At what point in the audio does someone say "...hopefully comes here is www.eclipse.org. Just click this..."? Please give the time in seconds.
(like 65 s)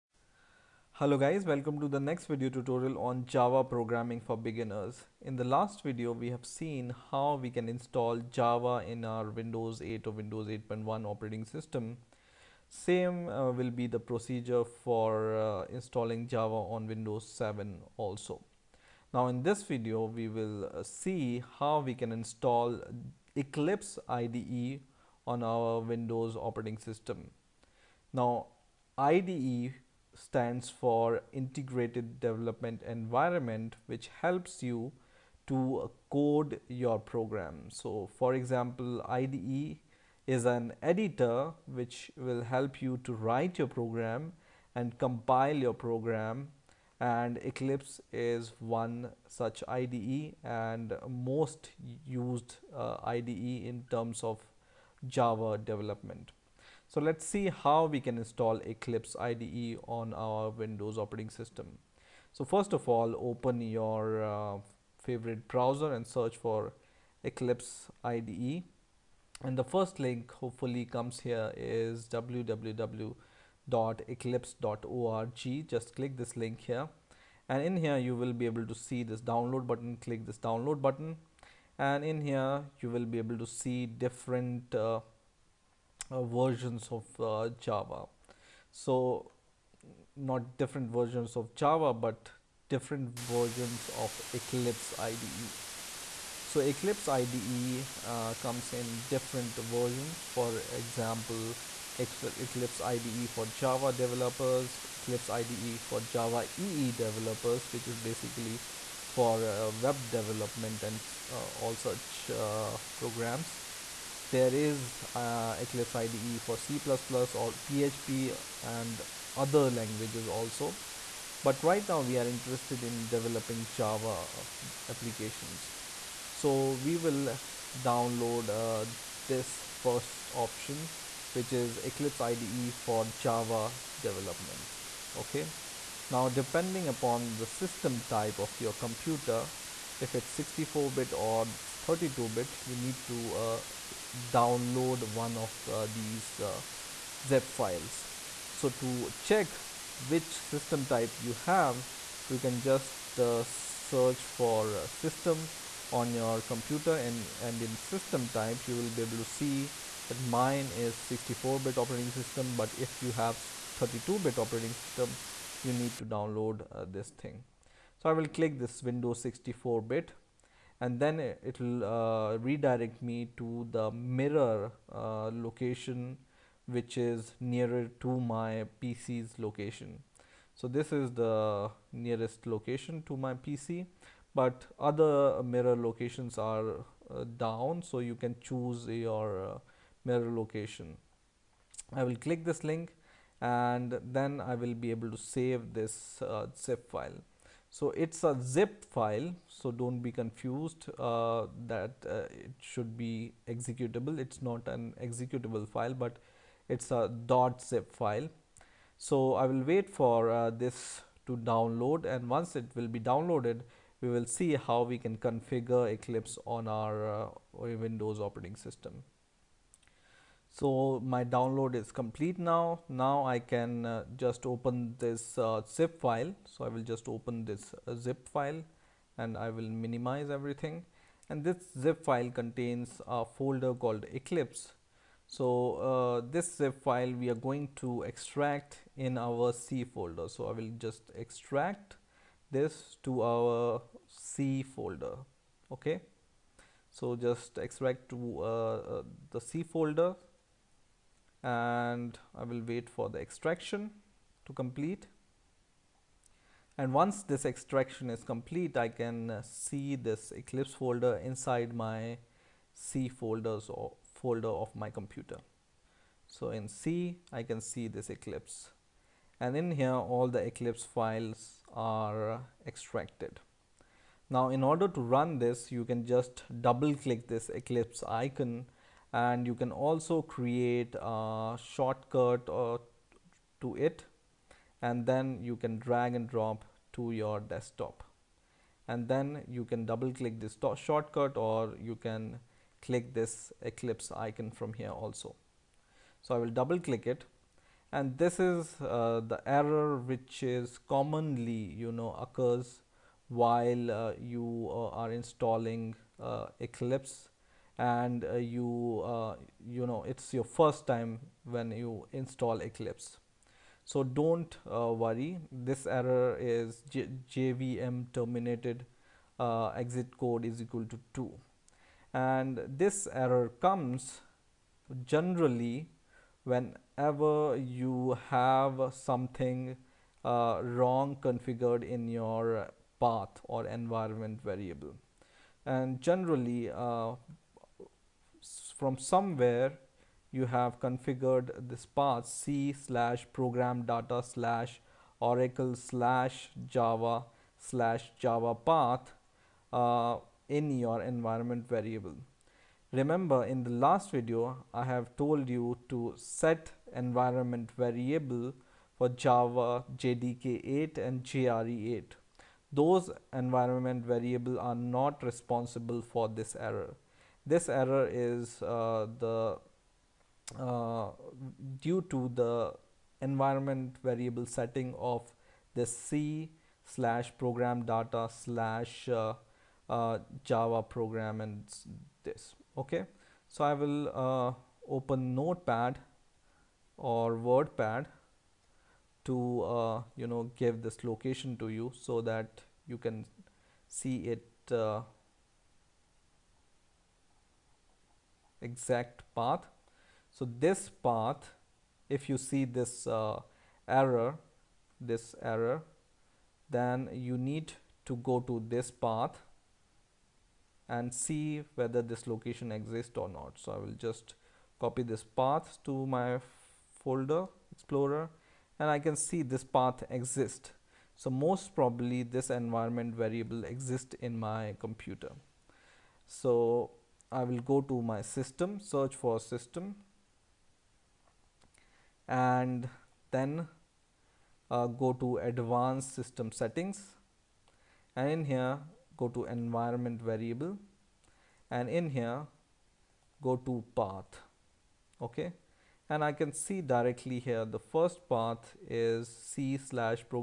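70 s.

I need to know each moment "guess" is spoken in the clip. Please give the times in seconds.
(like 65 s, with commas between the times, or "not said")
not said.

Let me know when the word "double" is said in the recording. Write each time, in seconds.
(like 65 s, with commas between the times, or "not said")
276 s, 289 s, 296 s.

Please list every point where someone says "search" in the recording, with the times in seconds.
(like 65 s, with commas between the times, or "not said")
66 s, 153 s, 428 s.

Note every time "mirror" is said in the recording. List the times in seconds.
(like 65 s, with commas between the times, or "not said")
173 s, 185 s, 190 s.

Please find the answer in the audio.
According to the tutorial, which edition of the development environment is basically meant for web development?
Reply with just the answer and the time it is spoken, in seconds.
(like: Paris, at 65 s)
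Eclipse IDE for Java EE developers, at 105 s.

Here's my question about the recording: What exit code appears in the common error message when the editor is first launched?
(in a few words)
2.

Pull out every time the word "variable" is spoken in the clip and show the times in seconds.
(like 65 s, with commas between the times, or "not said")
334 s, 351 s, 357 s, 364 s, 374 s, 423 s, 440 s.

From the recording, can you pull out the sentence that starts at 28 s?
Now IDE stands for integrated development environment which helps you to code your program.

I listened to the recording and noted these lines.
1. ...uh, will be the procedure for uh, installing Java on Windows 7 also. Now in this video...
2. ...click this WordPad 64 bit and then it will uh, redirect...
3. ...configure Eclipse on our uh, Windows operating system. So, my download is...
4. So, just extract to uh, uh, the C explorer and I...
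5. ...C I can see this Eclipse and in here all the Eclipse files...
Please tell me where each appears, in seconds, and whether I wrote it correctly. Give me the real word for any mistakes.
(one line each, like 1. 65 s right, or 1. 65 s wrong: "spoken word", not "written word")
1. 13 s right
2. 168 s wrong: "Windows", not "WordPad"
3. 215 s right
4. 246 s wrong: "folder", not "explorer"
5. 266 s right.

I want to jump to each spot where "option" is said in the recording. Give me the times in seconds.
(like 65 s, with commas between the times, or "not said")
130 s.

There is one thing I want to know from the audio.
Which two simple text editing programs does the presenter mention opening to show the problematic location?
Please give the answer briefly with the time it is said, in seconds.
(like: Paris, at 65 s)
Notepad or WordPad, at 385 s.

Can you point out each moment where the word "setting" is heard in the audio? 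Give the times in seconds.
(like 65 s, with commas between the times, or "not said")
374 s, 436 s.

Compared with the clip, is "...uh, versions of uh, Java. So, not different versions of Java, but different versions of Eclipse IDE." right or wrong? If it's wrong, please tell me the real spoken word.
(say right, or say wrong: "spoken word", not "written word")
right.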